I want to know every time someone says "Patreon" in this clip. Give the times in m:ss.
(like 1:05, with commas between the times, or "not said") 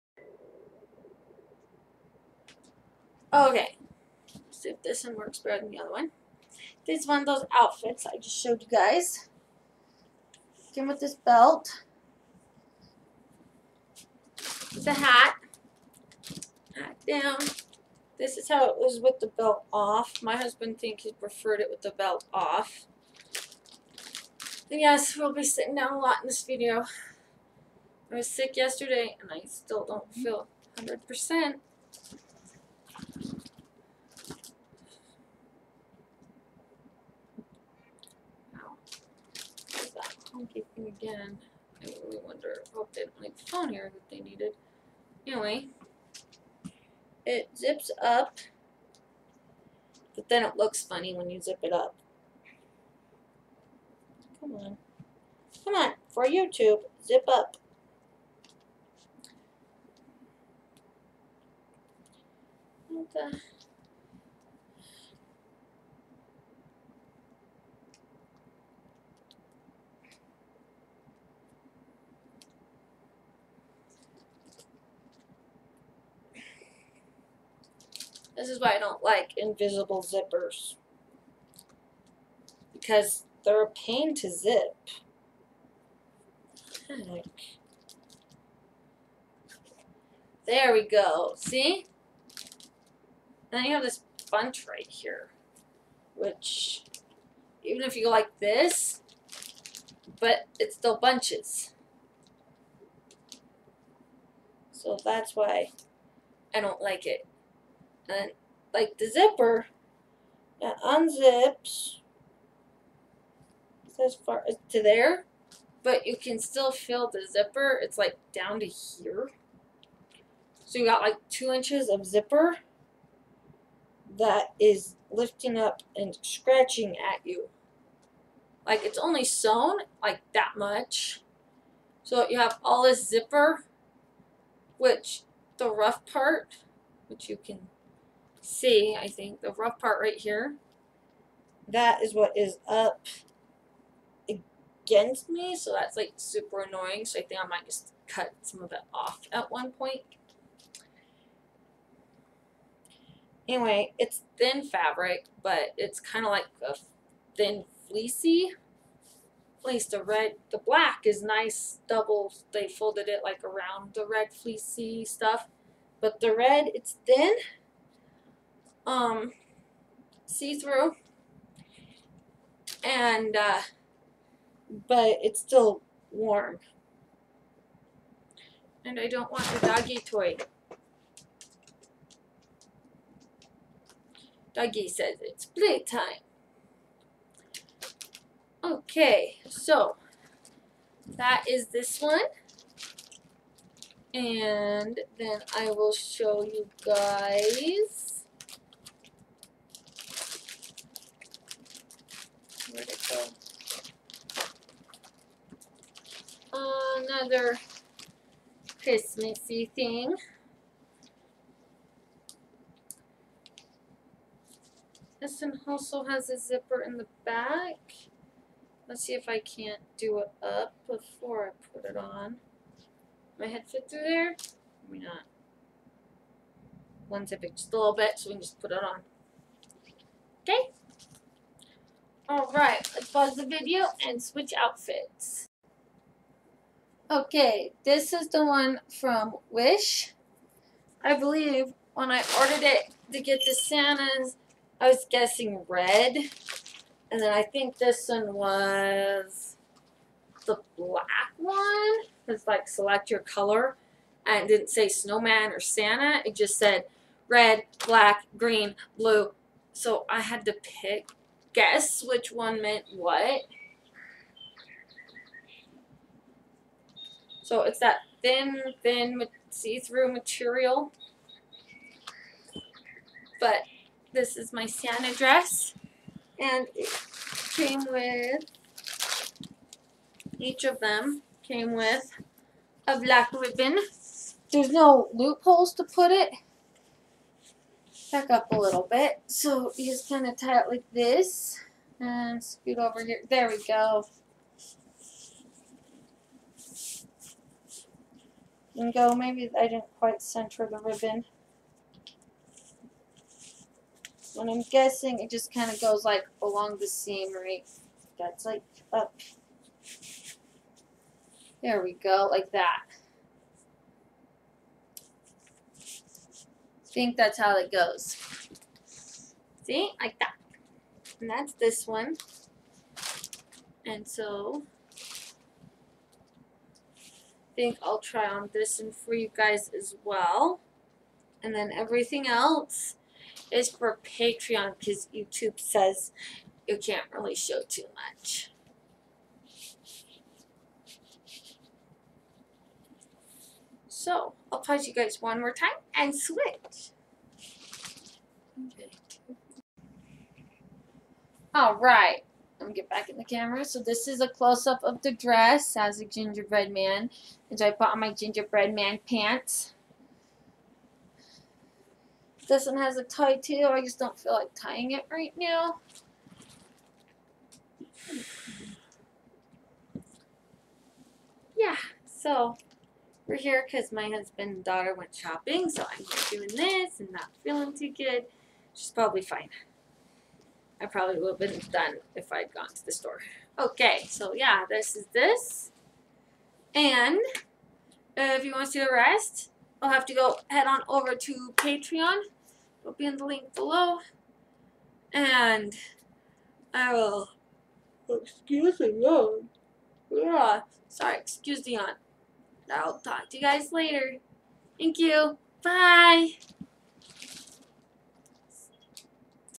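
5:34, 6:31.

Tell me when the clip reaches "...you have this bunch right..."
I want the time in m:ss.
1:33.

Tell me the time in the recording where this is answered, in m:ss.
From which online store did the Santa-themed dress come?
3:59.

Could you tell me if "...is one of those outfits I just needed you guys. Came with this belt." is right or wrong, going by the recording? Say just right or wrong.
wrong.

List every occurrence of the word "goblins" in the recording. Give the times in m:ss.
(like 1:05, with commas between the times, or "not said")
not said.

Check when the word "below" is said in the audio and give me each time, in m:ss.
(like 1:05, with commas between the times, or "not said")
6:33.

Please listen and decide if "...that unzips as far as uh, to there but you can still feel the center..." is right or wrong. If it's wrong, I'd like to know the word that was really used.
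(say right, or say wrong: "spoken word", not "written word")
wrong: "zipper", not "center".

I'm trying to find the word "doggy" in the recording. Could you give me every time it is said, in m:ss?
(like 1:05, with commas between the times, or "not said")
2:59, 3:04.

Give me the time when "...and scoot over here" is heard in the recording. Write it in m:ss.
4:51.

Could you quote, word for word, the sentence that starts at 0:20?
My husband thinks he preferred it with the belt off.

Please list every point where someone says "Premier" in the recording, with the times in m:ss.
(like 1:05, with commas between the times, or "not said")
not said.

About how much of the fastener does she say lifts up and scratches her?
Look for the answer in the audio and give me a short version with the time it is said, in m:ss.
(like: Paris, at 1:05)
2 inches, at 2:01.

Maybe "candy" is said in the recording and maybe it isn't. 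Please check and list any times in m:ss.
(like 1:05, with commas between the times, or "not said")
not said.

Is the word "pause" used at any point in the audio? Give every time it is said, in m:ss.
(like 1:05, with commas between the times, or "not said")
3:53, 5:44.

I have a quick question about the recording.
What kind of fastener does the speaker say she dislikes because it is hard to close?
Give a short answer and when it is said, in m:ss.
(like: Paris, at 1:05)
Invisible zippers, at 1:19.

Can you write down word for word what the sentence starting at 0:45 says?
Anyway, it zips up, but then it looks funny when you zip it up.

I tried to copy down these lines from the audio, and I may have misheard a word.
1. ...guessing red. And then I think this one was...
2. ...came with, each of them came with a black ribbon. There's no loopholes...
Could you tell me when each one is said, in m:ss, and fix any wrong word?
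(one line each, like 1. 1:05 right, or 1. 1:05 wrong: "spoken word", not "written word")
1. 4:05 right
2. 4:37 right.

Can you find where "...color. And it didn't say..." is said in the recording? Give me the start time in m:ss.
4:13.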